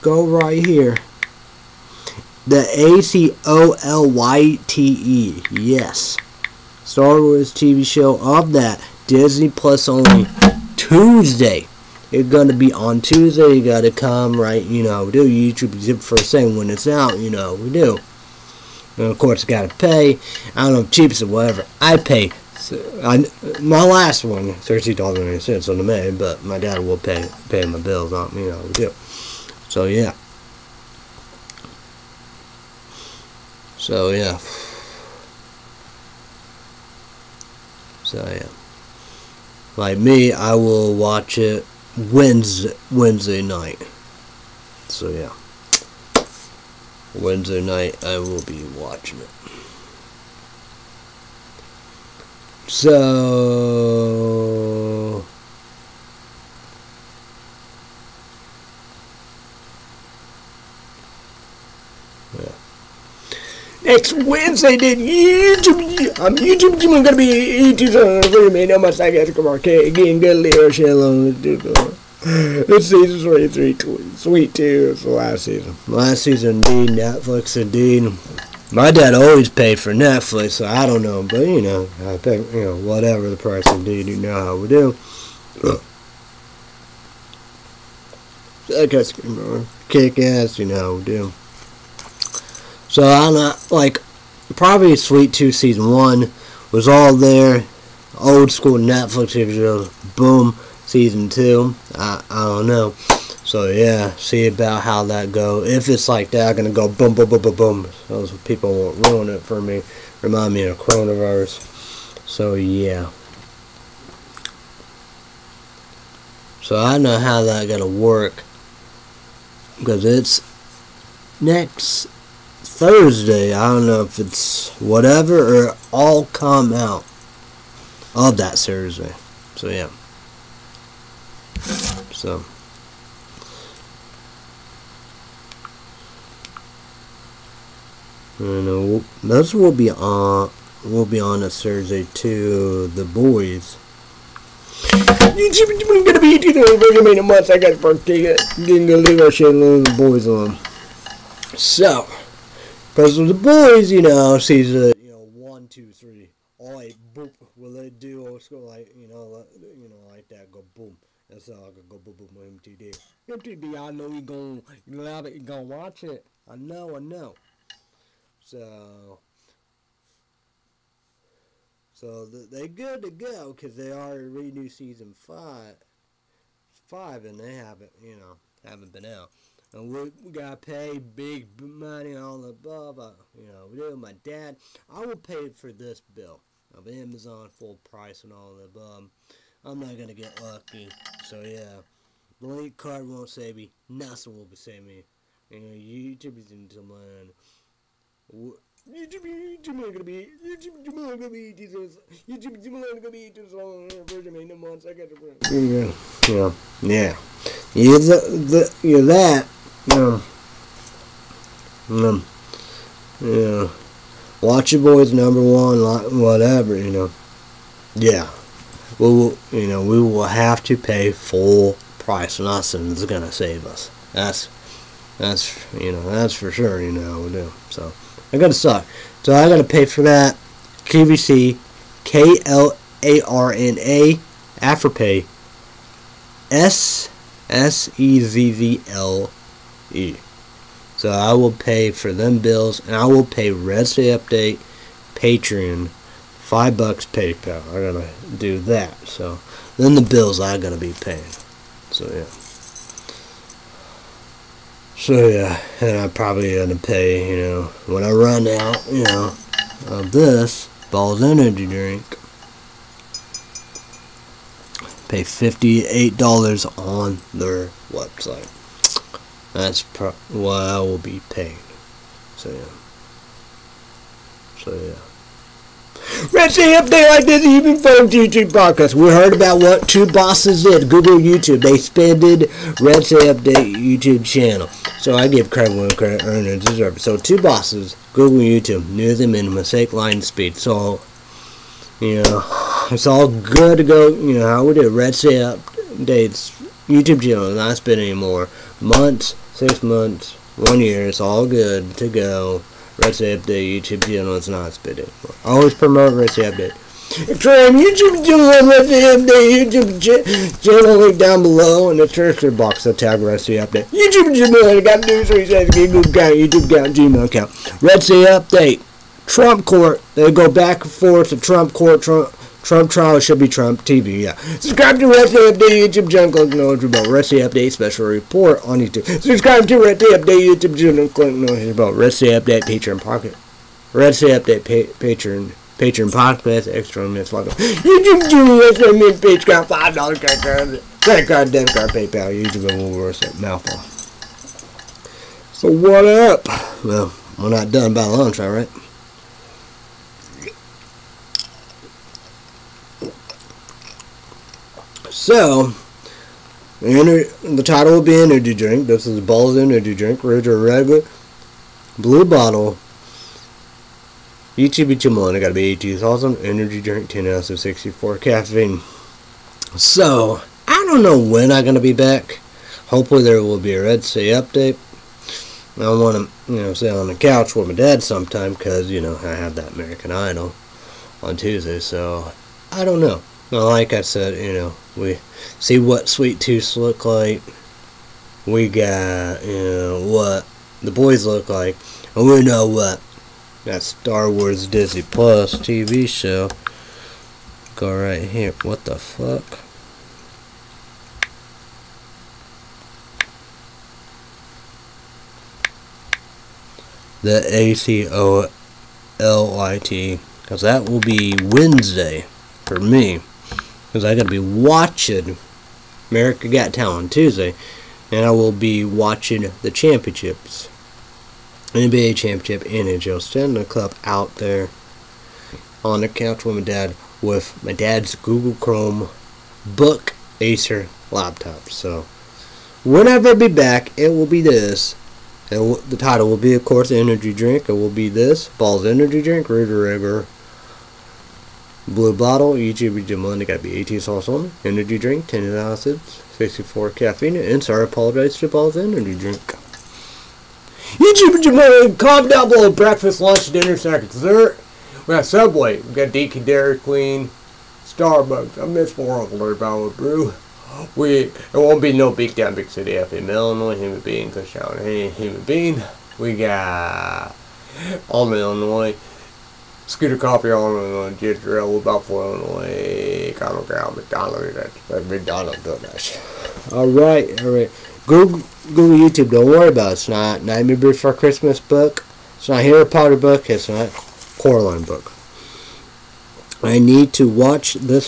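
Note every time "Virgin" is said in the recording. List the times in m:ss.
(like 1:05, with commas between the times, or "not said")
2:26, 3:24.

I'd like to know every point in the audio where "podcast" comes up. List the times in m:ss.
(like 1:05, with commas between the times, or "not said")
4:38, 5:36.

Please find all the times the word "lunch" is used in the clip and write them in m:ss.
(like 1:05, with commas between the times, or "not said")
5:48, 7:33.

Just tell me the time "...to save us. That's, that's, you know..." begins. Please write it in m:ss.
3:43.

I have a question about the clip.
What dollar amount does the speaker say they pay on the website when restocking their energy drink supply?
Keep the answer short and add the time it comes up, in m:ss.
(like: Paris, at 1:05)
58 dollars, at 4:25.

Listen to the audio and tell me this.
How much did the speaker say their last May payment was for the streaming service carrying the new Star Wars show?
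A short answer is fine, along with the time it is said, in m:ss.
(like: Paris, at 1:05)
$13.90, at 0:24.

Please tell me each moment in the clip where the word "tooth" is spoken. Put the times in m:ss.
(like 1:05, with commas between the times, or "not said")
1:35, 6:26.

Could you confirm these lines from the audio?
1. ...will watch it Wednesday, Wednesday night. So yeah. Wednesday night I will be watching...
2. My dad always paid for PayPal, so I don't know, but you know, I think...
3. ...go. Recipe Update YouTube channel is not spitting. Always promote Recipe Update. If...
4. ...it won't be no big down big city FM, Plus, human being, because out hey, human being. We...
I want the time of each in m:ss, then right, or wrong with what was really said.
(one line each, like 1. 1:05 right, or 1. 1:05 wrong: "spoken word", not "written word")
1. 0:40 right
2. 1:18 wrong: "Netflix", not "PayPal"
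3. 5:02 right
4. 7:41 wrong: "Illinois", not "Plus".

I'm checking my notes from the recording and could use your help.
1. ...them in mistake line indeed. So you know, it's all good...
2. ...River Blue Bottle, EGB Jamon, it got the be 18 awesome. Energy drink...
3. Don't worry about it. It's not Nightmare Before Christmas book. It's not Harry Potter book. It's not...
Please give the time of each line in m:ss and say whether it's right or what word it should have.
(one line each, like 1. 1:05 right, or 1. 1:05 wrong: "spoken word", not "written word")
1. 4:49 wrong: "speed", not "indeed"
2. 7:19 right
3. 7:59 right.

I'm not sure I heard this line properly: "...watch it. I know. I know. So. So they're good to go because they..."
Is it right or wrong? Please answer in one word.
right.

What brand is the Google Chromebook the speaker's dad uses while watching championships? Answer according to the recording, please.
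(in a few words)
Acer.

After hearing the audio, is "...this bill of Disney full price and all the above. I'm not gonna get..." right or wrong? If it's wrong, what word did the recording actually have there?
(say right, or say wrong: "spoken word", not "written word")
wrong: "Amazon", not "Disney".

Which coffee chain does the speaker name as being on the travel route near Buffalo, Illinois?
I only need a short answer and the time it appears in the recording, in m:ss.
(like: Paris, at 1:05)
Scooter's Coffee, at 7:49.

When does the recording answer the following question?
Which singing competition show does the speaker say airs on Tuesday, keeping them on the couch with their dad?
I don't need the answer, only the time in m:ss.
6:19.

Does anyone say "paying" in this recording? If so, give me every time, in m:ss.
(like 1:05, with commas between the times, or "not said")
4:10, 4:31.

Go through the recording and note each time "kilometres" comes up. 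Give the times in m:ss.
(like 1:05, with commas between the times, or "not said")
not said.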